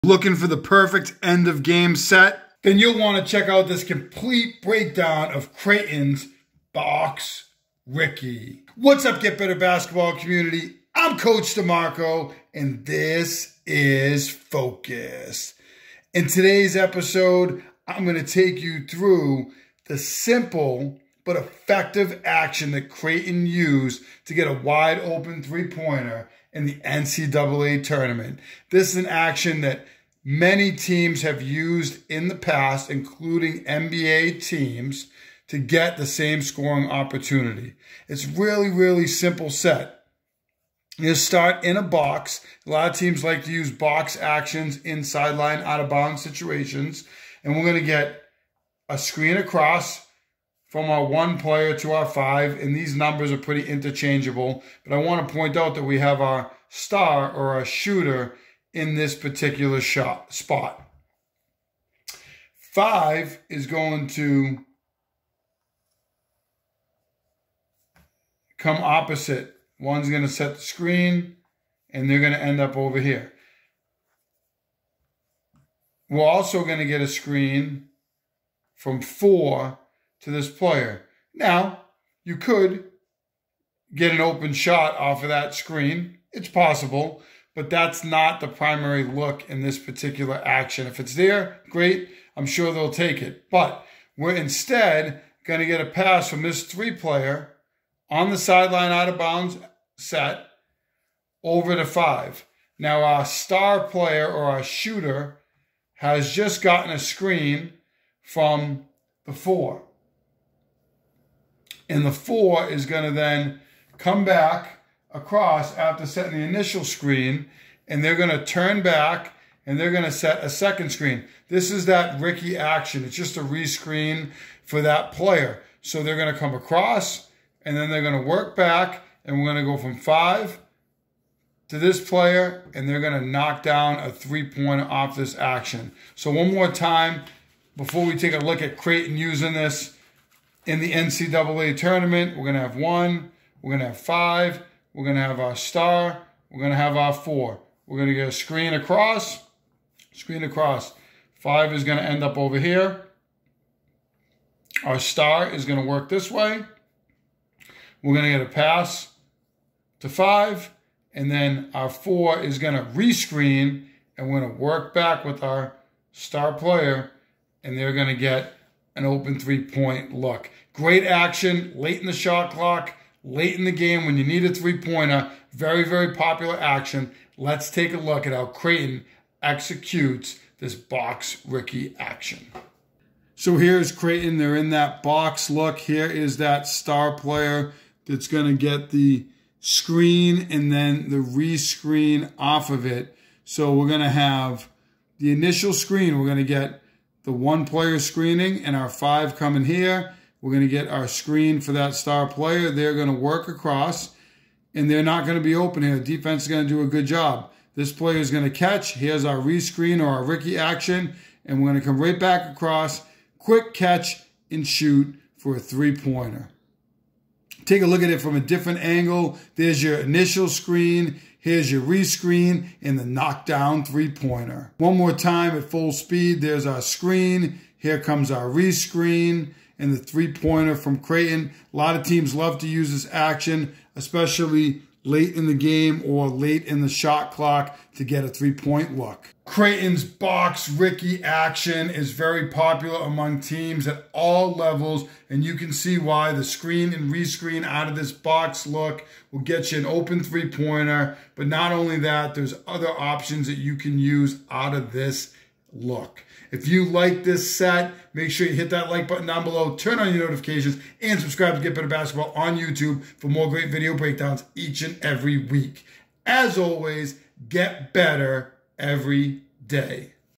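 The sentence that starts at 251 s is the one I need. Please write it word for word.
But not only that, there's other options that you can use out of this look.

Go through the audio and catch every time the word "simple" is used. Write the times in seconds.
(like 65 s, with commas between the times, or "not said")
19 s, 39 s.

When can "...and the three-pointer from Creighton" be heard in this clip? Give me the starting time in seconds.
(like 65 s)
229 s.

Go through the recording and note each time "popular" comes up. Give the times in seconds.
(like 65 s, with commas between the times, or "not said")
176 s, 242 s.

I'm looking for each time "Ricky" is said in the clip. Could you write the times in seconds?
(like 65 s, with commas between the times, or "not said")
7 s, 122 s, 181 s, 210 s, 240 s.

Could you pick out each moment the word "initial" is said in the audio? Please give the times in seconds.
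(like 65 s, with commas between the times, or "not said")
116 s, 195 s, 219 s.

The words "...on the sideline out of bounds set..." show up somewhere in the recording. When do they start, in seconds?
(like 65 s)
98 s.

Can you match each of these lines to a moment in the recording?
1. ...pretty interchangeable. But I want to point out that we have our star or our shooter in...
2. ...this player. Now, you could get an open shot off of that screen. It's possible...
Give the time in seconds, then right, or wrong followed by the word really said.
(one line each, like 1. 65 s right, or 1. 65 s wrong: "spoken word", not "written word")
1. 53 s right
2. 80 s right.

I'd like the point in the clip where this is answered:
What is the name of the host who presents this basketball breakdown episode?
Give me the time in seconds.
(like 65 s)
11 s.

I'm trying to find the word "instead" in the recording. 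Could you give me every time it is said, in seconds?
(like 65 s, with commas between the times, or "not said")
94 s.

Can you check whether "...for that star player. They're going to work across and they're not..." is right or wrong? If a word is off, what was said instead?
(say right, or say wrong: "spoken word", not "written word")
right.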